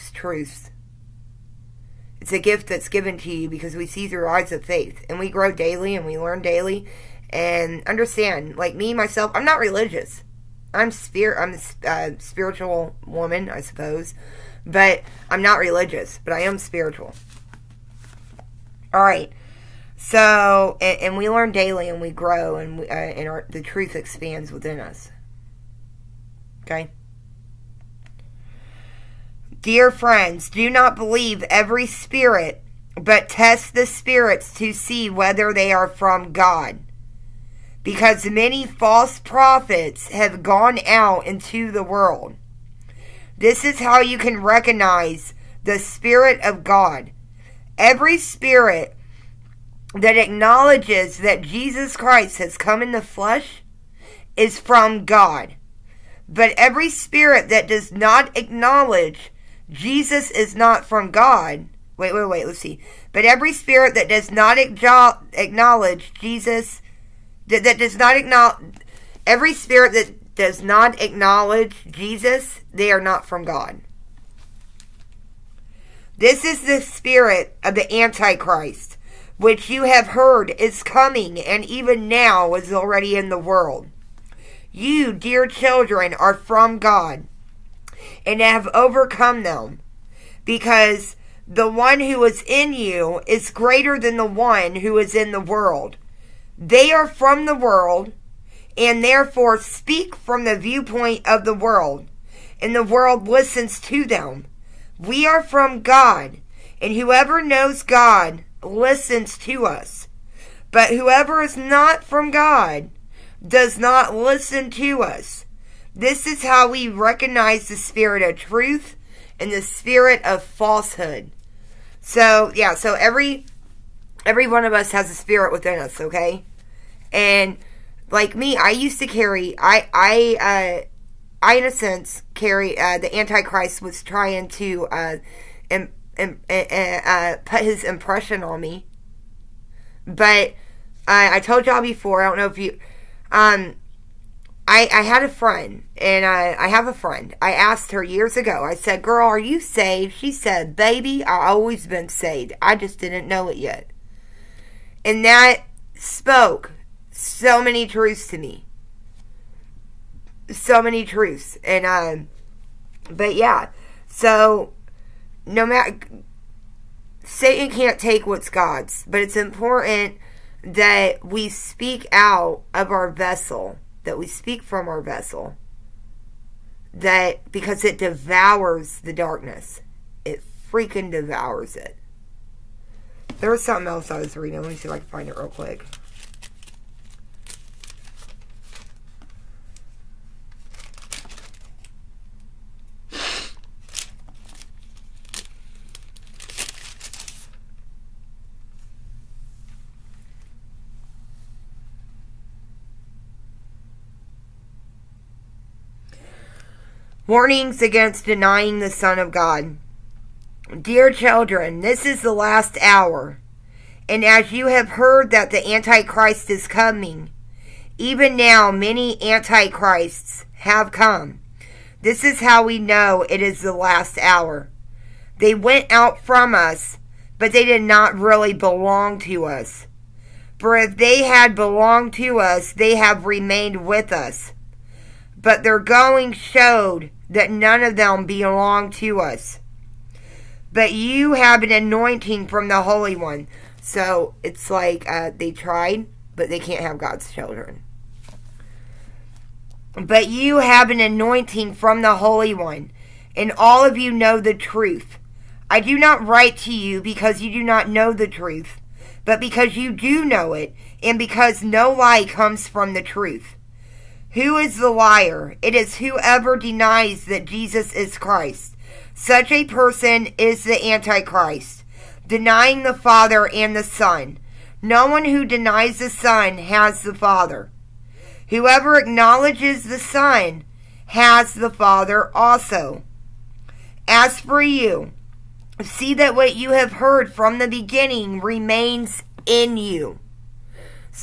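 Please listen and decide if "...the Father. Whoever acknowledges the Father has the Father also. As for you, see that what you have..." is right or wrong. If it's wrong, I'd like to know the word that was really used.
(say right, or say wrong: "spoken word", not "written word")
wrong: "Son", not "Father".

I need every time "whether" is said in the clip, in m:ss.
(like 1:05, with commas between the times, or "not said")
0:35.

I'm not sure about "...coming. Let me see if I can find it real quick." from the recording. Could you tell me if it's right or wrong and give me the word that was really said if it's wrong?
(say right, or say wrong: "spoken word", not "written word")
wrong: "reading", not "coming".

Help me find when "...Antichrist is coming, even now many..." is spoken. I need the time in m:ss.
3:35.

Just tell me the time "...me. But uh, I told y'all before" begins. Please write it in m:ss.
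2:18.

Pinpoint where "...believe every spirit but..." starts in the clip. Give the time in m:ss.
0:30.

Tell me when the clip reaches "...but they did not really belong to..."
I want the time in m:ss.
3:47.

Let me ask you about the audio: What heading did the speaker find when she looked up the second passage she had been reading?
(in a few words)
Warnings against denying the Son of God.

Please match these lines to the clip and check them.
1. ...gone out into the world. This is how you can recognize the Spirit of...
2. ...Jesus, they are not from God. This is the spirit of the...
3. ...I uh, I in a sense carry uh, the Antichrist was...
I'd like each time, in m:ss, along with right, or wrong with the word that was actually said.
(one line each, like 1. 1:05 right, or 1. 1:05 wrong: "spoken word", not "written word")
1. 0:40 right
2. 1:11 right
3. 2:09 right.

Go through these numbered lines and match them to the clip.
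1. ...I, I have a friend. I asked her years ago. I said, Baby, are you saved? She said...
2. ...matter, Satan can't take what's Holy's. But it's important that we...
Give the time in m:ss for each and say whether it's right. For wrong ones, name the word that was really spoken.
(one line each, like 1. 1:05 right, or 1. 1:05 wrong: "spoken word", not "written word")
1. 2:26 wrong: "Girl", not "Baby"
2. 2:45 wrong: "God", not "Holy".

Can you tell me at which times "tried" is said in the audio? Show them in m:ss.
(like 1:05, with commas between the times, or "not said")
4:05.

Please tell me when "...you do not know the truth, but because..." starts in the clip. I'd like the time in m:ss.
4:17.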